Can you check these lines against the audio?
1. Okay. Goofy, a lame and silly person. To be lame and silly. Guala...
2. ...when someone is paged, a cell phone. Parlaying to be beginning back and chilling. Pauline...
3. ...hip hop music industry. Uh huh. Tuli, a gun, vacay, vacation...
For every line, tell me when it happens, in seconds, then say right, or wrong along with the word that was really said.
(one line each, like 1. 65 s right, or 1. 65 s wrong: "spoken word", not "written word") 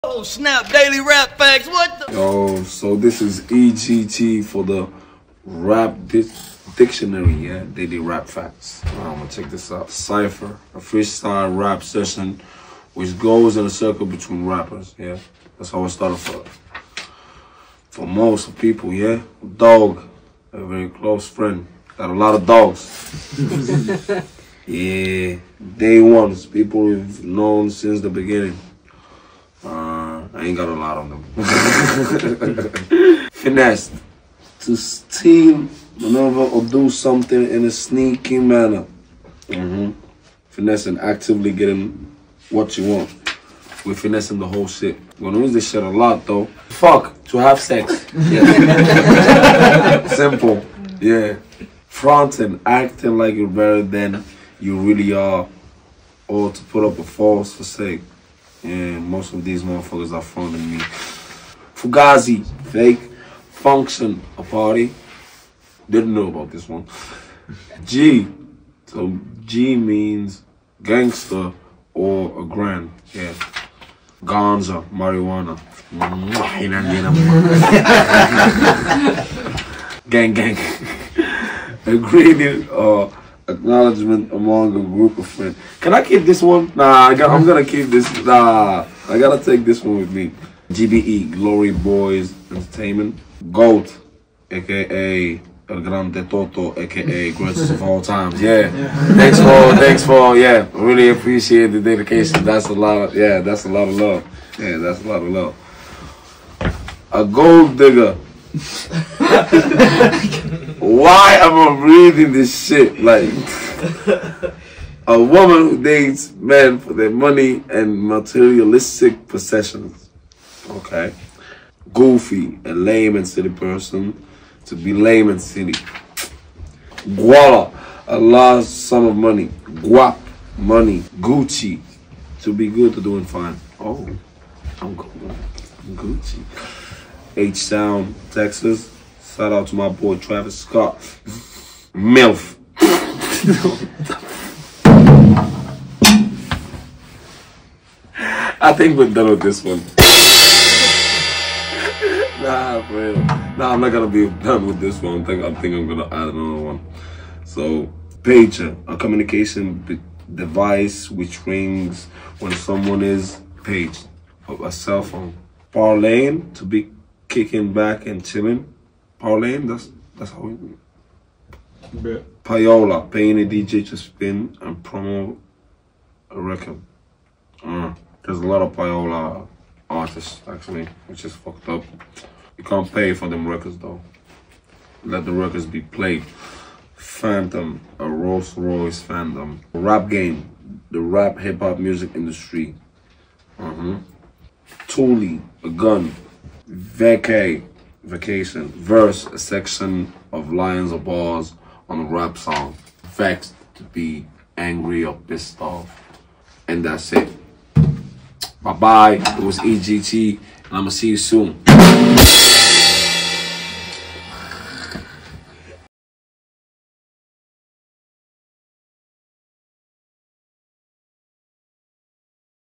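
1. 120 s right
2. 162 s wrong: "kicking", not "beginning"
3. 191 s right.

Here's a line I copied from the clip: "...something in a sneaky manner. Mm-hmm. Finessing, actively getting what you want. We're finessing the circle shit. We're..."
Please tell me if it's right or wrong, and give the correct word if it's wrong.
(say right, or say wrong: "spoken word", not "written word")
wrong: "whole", not "circle".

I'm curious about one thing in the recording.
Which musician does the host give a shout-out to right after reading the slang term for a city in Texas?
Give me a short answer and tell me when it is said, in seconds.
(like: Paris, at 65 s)
Travis Scott, at 140 s.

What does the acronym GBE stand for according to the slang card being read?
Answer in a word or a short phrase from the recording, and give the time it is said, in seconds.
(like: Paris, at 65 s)
Glory Boys Entertainment, at 91 s.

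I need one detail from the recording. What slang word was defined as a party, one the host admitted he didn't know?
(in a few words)
Function.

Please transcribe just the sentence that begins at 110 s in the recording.
Why am I reading this shit?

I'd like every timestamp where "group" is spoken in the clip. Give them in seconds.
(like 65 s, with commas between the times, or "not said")
84 s.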